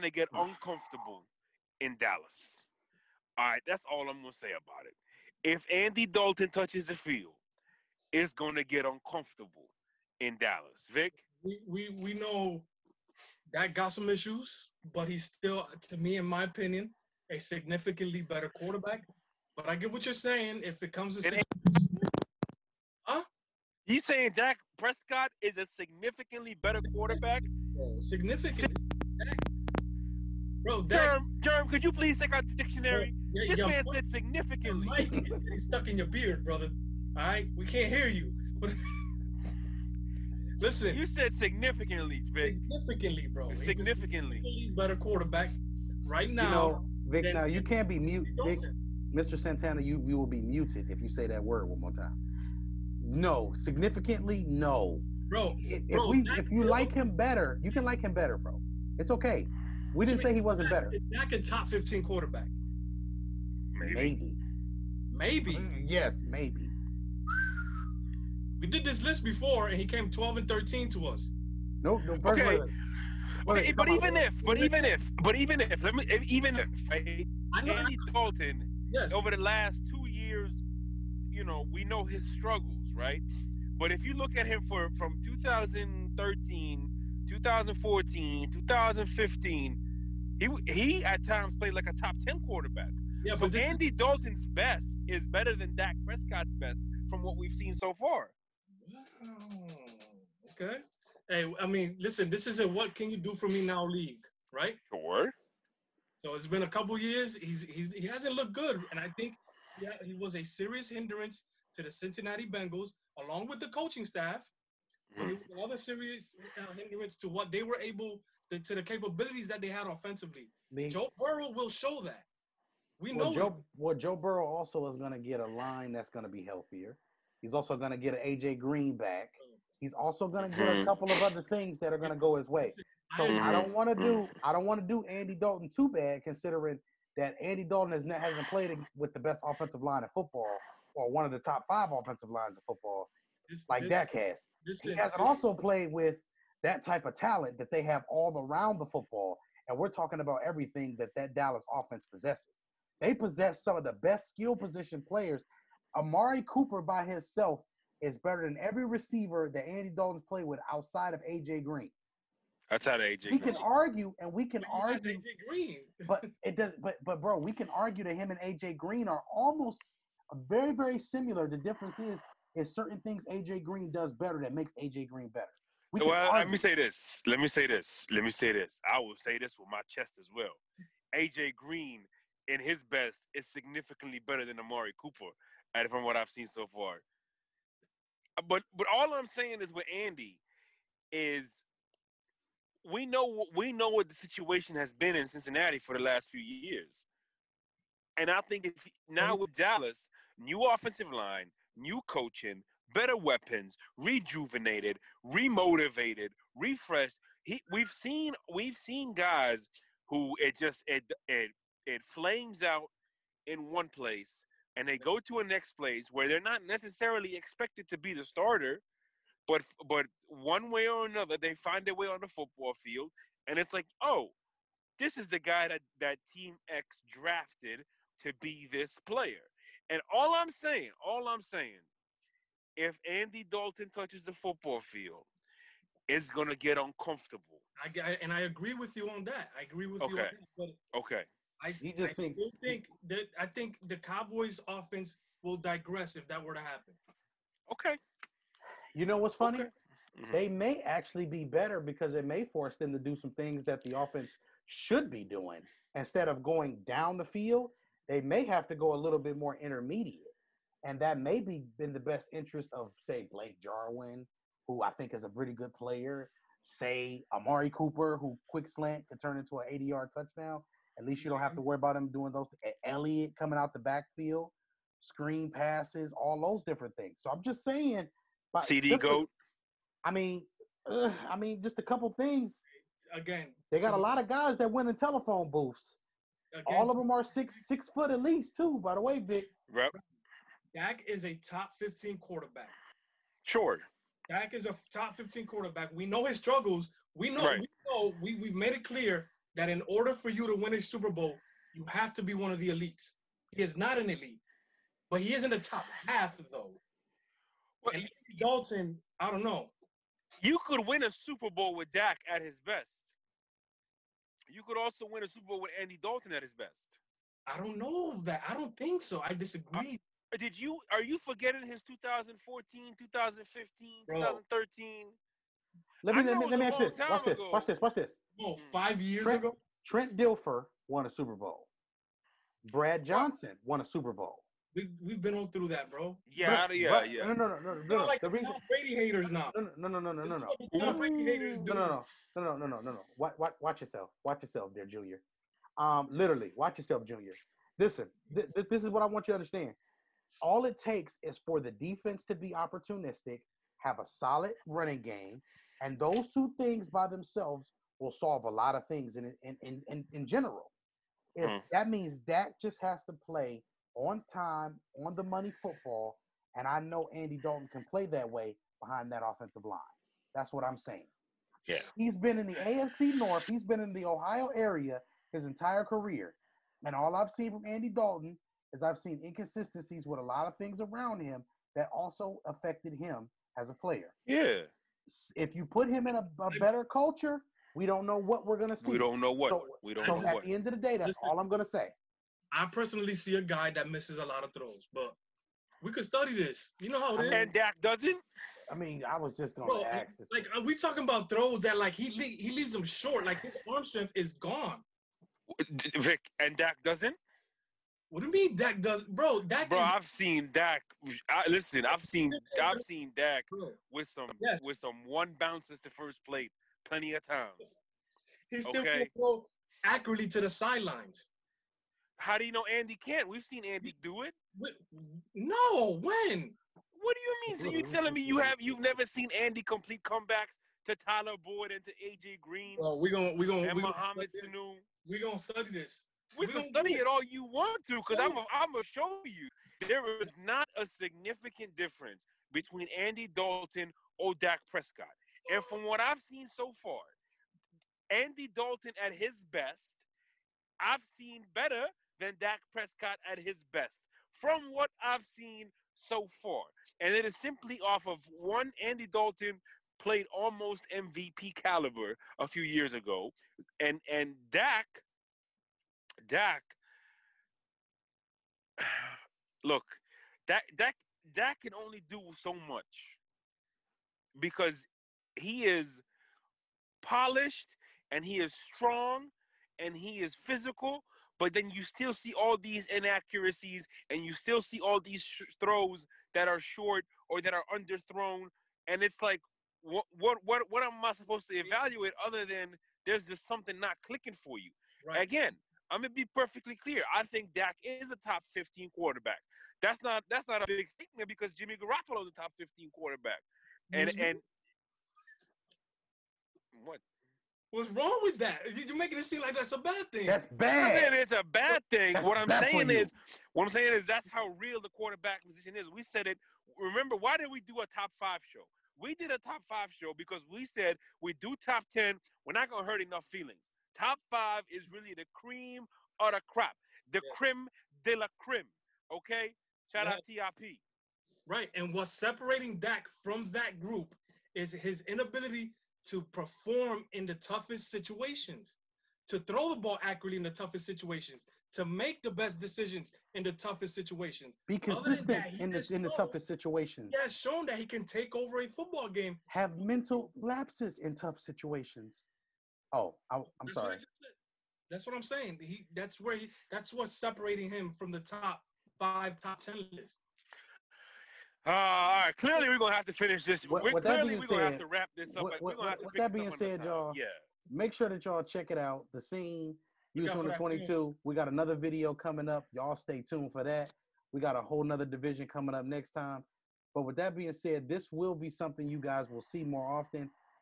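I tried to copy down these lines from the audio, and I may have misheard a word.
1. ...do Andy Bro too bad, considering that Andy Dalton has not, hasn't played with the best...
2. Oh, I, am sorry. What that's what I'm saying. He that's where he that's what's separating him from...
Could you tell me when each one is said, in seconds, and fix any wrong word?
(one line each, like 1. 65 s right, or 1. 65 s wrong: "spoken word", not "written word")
1. 134 s wrong: "Dalton", not "Bro"
2. 552 s right.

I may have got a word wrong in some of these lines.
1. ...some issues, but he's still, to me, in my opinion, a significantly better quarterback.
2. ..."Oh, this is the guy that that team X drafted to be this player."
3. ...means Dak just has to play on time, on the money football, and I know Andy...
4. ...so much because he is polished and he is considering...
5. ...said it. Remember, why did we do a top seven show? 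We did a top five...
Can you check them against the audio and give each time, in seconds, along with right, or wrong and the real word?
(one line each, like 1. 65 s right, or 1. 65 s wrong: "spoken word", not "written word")
1. 13 s right
2. 224 s right
3. 361 s right
4. 472 s wrong: "strong", not "considering"
5. 516 s wrong: "five", not "seven".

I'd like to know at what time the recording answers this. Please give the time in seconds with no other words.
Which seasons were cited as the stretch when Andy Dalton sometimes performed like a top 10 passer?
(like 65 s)
85 s.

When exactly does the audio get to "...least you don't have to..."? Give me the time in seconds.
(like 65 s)
271 s.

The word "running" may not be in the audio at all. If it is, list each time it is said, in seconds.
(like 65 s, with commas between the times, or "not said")
354 s.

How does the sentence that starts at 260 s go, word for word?
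And that may be in the best interest of, say, Blake Jarwin, who I think is a pretty good player.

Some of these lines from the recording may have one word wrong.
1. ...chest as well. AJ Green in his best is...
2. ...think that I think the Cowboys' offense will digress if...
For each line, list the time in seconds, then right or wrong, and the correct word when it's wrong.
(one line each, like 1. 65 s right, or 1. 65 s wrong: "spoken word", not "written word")
1. 179 s right
2. 242 s right.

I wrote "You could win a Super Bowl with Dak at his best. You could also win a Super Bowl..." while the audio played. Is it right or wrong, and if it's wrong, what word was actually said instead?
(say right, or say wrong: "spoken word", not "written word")
right.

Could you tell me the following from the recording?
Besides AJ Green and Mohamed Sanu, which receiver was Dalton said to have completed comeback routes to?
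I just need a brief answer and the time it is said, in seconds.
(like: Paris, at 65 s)
Tyler Boyd, at 430 s.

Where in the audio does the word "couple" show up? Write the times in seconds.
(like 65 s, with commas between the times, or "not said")
106 s, 130 s, 281 s.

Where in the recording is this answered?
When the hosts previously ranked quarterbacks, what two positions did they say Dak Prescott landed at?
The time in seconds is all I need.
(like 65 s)
70 s.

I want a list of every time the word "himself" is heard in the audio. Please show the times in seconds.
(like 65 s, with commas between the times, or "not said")
157 s.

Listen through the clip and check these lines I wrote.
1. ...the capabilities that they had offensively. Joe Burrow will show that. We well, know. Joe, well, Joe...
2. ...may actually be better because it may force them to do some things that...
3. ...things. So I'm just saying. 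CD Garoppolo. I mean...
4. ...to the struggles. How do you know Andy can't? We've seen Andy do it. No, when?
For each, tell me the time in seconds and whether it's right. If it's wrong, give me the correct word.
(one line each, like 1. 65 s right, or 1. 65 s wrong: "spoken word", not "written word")
1. 118 s right
2. 250 s right
3. 276 s wrong: "Goat", not "Garoppolo"
4. 420 s wrong: "sidelines", not "struggles".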